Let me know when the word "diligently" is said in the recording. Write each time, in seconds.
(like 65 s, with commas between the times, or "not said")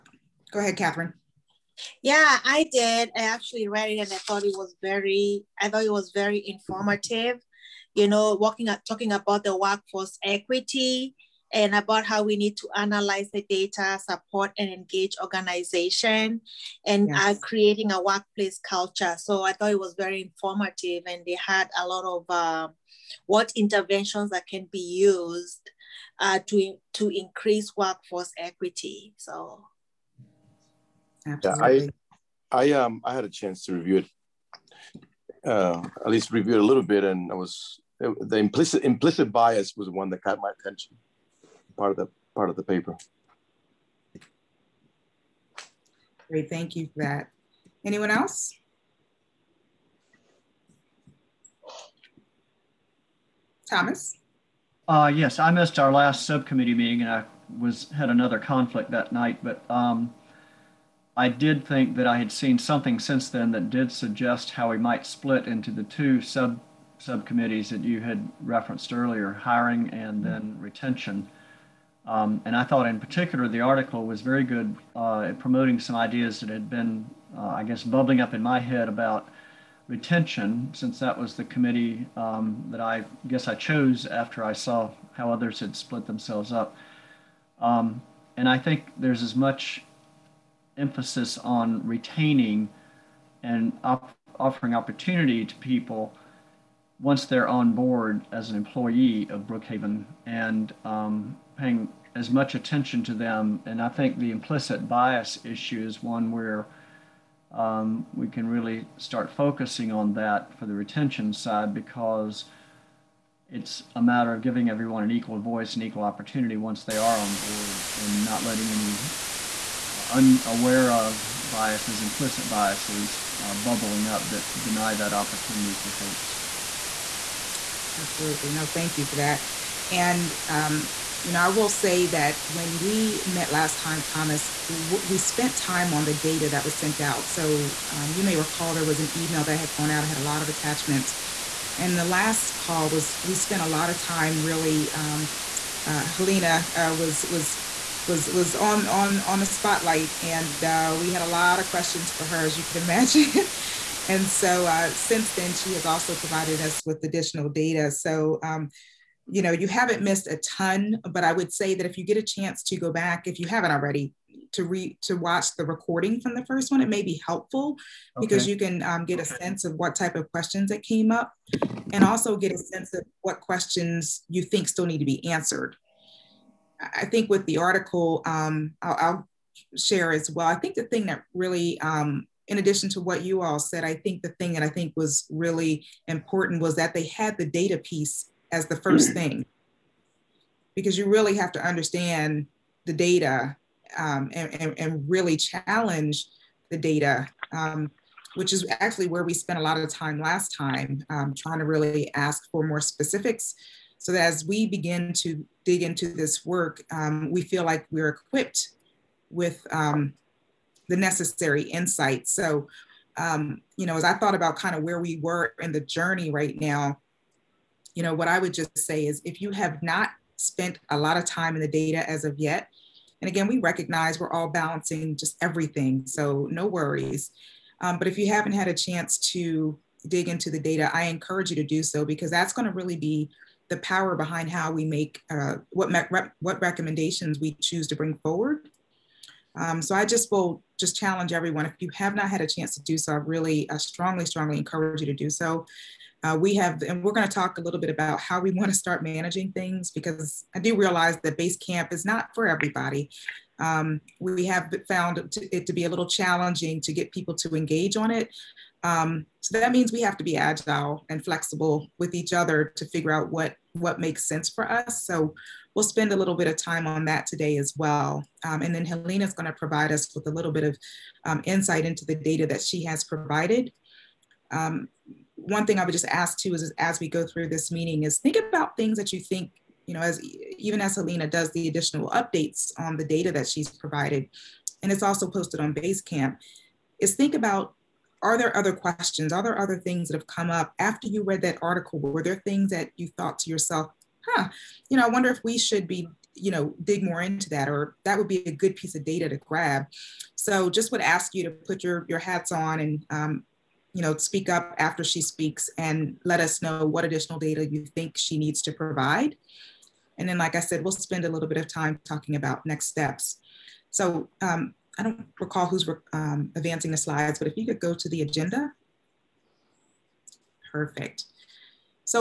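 not said.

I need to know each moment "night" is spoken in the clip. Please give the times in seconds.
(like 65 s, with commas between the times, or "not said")
59 s.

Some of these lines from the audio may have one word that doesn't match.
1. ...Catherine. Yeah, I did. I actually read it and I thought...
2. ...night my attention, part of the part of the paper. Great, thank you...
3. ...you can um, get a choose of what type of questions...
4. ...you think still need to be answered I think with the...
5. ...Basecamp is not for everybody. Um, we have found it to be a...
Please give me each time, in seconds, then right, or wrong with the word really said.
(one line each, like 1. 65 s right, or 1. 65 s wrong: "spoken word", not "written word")
1. 0 s right
2. 40 s wrong: "caught", not "night"
3. 168 s wrong: "sense", not "choose"
4. 174 s right
5. 251 s right.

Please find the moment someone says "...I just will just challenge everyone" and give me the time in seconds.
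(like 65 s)
239 s.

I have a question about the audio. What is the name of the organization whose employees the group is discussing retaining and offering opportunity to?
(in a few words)
Brookhaven.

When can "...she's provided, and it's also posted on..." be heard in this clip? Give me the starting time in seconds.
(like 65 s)
283 s.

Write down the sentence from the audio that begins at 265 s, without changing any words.
So we'll spend a little bit of time on that today as well.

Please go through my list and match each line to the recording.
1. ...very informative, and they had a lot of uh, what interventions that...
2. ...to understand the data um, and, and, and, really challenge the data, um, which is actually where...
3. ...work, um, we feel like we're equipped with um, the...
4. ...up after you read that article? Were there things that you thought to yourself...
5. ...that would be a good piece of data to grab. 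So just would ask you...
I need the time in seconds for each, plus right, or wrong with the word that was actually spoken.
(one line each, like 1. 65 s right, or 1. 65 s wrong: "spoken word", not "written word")
1. 19 s right
2. 191 s right
3. 206 s right
4. 290 s right
5. 298 s right.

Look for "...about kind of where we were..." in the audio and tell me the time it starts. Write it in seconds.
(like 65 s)
214 s.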